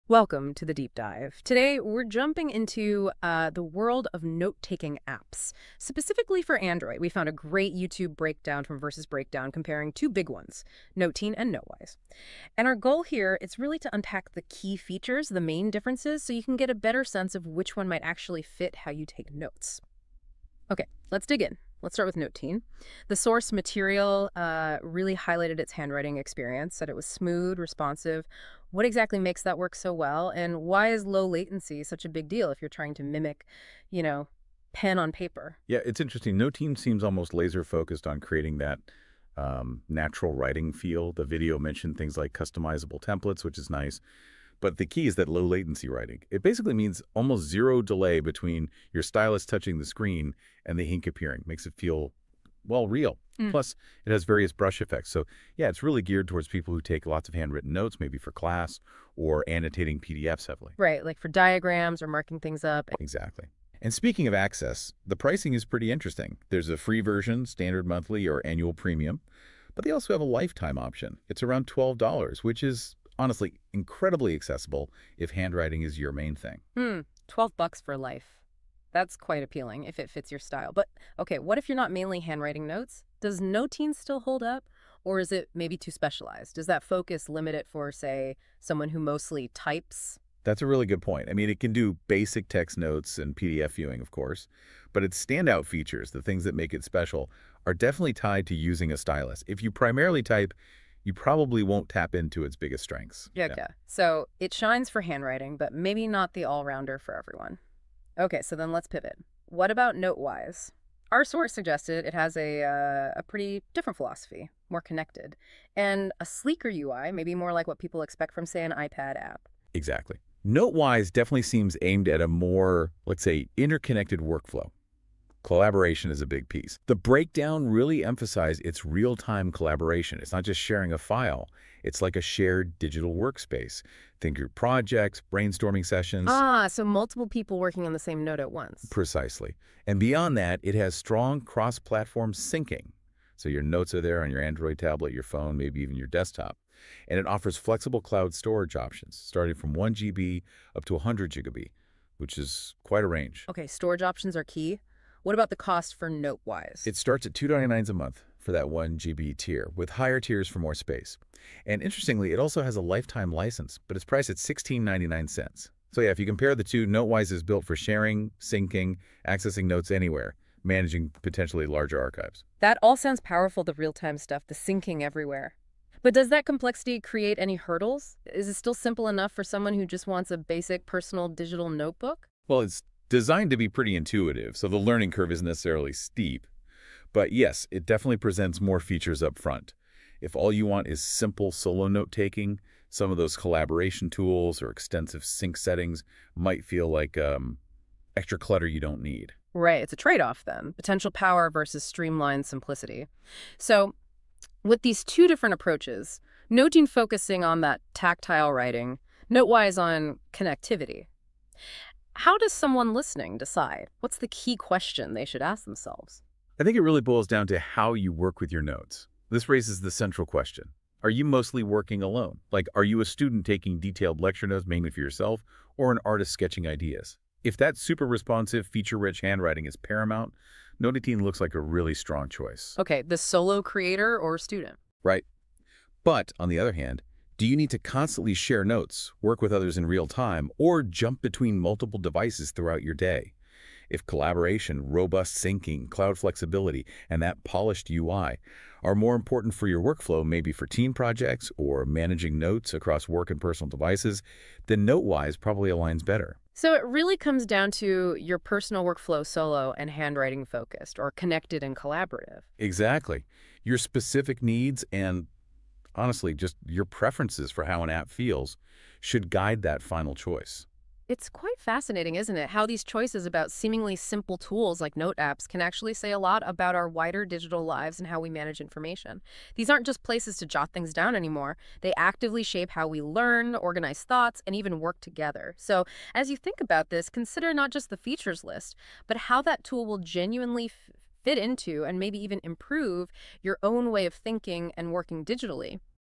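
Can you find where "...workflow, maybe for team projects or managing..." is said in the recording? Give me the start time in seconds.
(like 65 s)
249 s.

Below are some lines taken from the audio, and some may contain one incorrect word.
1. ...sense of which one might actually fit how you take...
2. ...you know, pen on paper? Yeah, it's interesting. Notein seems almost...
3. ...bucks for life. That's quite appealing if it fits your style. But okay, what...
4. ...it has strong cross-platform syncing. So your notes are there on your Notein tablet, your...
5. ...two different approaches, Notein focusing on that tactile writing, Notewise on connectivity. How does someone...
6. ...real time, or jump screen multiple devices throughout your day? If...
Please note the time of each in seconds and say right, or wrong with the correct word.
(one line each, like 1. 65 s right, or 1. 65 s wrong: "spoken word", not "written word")
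1. 17 s right
2. 33 s right
3. 77 s right
4. 140 s wrong: "Android", not "Notein"
5. 205 s right
6. 239 s wrong: "between", not "screen".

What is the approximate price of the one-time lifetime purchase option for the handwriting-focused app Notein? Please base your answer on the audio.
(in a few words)
$12.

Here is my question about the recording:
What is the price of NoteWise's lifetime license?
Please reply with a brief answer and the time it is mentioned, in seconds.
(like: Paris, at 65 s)
$16.99, at 164 s.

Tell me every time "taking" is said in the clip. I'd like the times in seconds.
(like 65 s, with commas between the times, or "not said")
4 s, 191 s, 223 s.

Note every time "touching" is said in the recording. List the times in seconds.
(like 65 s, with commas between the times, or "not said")
49 s.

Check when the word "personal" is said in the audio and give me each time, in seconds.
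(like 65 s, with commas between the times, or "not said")
180 s, 253 s, 258 s.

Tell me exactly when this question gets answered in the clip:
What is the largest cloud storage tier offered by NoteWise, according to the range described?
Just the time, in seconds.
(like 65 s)
150 s.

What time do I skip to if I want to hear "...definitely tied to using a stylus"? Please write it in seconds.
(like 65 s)
97 s.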